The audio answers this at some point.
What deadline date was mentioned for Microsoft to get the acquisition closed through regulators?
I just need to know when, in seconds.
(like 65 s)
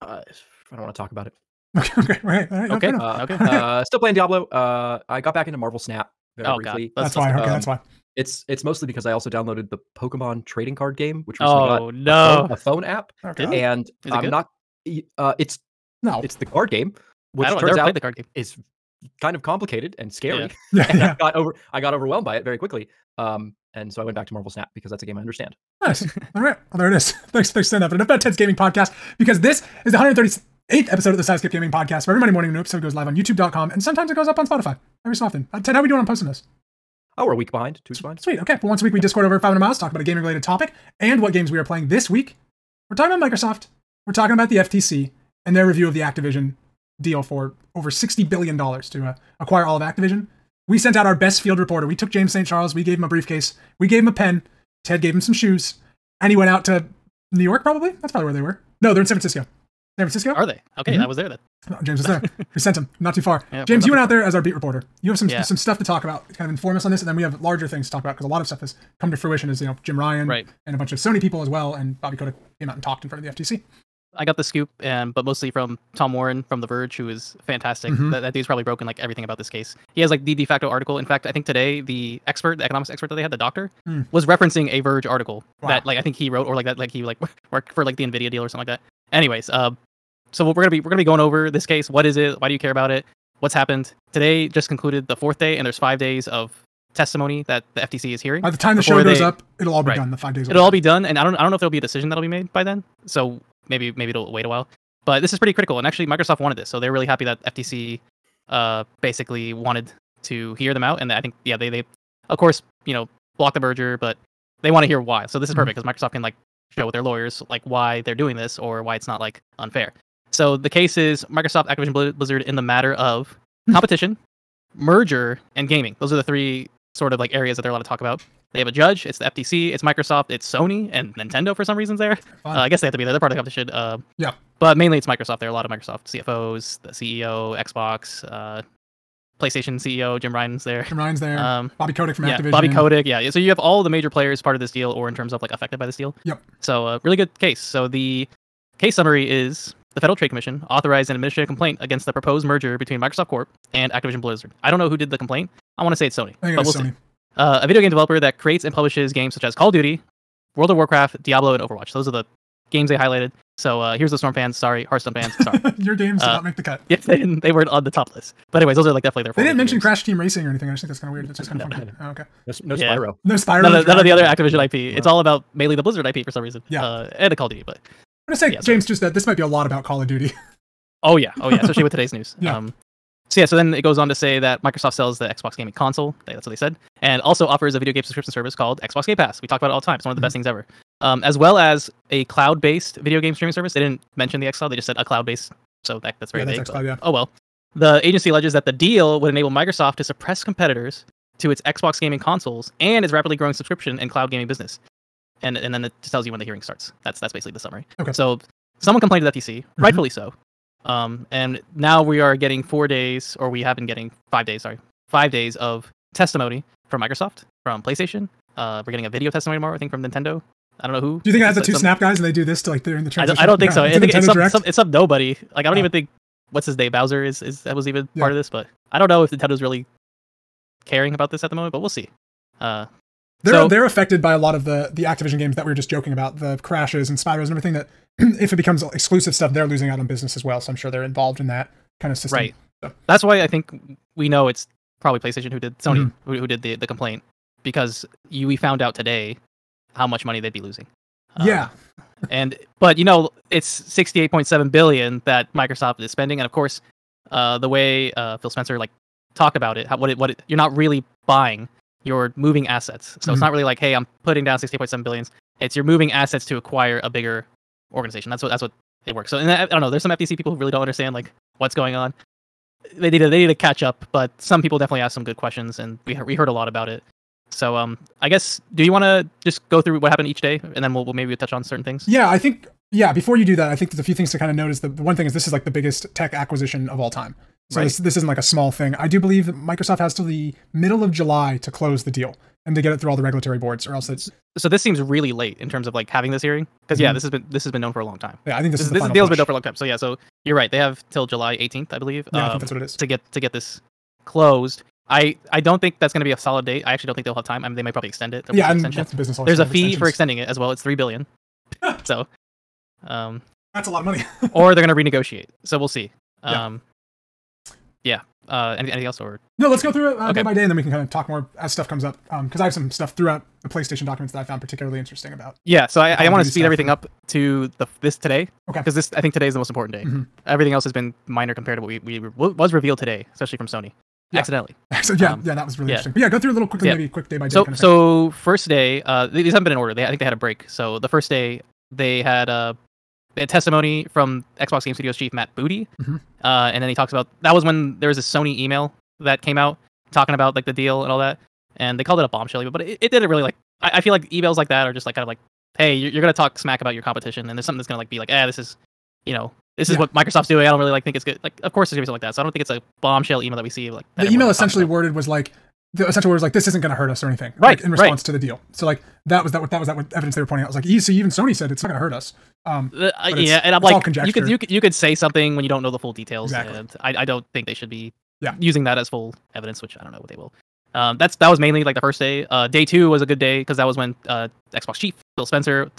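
301 s.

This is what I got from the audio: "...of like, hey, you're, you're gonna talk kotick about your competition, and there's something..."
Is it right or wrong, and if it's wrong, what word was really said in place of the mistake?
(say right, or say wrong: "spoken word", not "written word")
wrong: "smack", not "kotick".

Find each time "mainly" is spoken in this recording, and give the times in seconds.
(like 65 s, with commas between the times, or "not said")
134 s, 175 s, 381 s.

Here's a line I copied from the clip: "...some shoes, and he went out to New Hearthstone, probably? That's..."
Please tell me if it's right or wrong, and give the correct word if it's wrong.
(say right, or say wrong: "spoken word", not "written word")
wrong: "York", not "Hearthstone".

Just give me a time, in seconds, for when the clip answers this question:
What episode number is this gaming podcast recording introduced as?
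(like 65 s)
29 s.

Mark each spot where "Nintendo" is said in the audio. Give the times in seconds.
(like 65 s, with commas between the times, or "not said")
131 s, 220 s, 229 s.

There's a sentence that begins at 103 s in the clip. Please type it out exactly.
So maybe maybe it'll wait a while.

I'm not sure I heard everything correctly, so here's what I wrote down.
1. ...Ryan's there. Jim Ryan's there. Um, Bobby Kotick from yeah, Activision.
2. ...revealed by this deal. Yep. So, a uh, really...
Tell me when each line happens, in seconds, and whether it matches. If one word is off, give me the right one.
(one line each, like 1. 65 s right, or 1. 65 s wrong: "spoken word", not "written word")
1. 140 s right
2. 145 s wrong: "affected", not "revealed".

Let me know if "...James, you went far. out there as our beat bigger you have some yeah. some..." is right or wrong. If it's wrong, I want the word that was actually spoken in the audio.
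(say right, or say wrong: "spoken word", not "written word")
wrong: "reporter", not "bigger".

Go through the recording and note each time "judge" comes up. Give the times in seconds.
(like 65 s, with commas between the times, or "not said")
128 s.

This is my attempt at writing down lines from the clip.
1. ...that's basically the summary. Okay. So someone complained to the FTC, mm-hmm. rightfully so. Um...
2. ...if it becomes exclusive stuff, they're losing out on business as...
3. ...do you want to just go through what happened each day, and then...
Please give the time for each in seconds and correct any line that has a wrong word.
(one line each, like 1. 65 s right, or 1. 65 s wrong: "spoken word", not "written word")
1. 207 s right
2. 238 s right
3. 278 s right.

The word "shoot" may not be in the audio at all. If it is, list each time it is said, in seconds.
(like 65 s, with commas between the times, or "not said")
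not said.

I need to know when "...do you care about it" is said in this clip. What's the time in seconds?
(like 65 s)
92 s.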